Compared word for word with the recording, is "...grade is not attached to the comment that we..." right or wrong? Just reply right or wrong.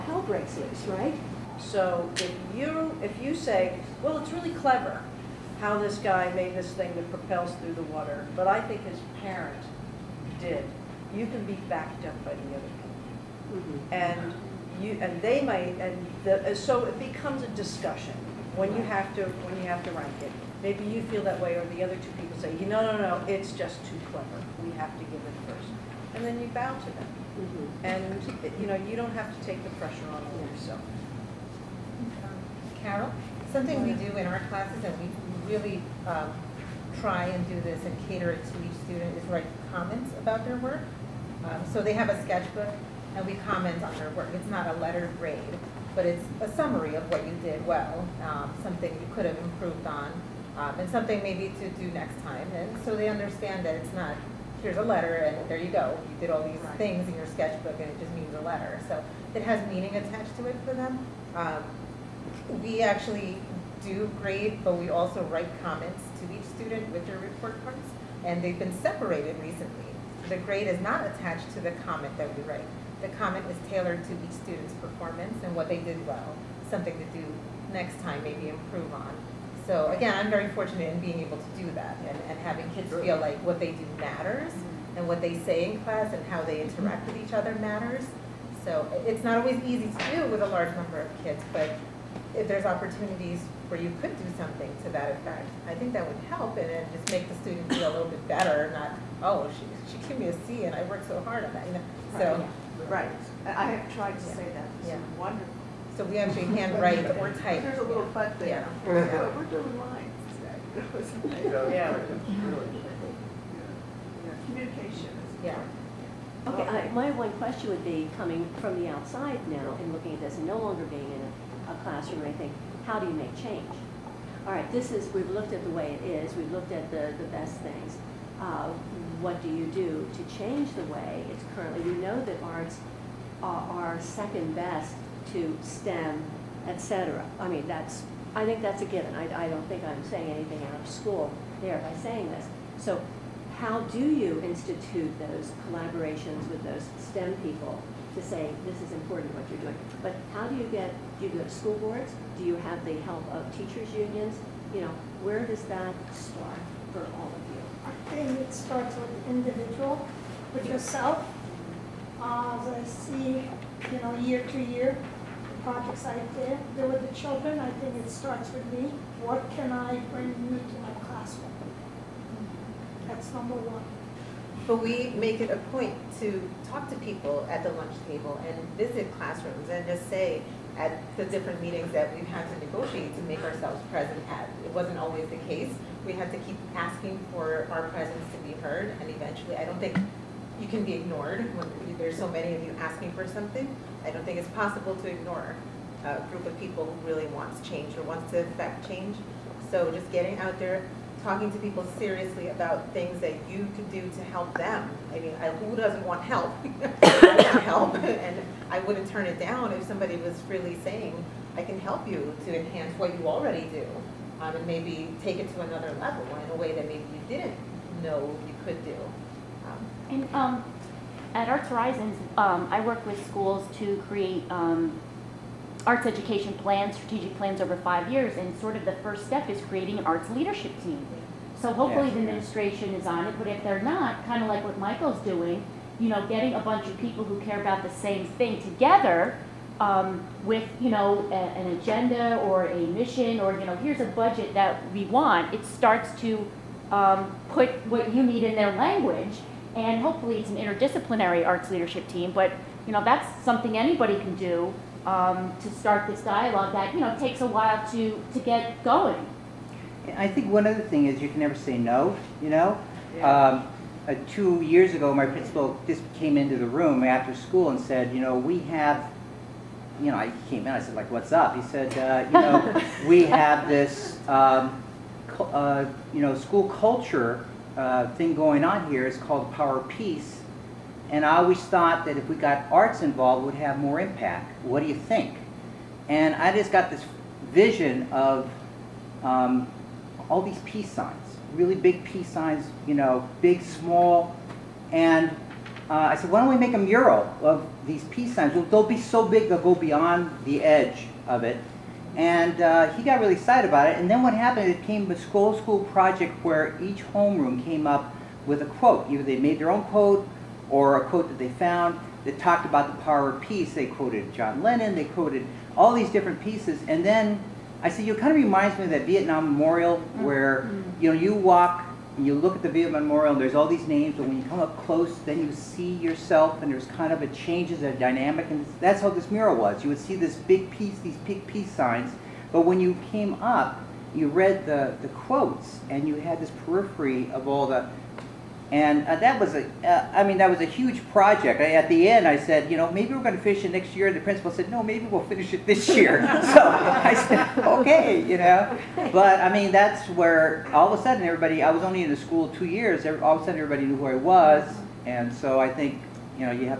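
right.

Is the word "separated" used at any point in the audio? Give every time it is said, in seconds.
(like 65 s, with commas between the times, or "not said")
68 s.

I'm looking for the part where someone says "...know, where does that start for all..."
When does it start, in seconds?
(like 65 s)
154 s.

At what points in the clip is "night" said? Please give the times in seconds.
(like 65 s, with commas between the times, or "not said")
not said.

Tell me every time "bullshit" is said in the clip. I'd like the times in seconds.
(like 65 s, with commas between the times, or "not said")
not said.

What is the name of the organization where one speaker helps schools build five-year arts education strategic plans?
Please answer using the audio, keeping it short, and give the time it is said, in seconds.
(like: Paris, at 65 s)
Arts Horizons, at 221 s.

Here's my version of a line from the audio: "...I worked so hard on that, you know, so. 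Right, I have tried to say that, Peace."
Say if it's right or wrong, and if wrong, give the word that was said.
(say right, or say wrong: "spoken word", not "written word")
wrong: "Yeah", not "Peace".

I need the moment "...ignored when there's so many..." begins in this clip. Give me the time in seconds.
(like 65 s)
190 s.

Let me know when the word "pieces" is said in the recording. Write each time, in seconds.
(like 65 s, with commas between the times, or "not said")
316 s, 330 s.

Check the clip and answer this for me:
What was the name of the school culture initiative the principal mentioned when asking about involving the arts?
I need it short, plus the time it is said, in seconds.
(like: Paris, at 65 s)
Power Peace, at 279 s.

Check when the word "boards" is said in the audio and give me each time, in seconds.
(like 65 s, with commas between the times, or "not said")
151 s.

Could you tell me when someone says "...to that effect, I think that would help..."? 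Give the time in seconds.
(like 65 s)
94 s.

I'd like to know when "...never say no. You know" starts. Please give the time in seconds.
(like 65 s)
261 s.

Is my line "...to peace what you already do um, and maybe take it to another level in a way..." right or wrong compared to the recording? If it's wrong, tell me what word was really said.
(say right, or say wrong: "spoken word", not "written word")
wrong: "enhance", not "peace".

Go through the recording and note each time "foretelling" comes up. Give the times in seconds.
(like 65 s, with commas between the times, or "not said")
not said.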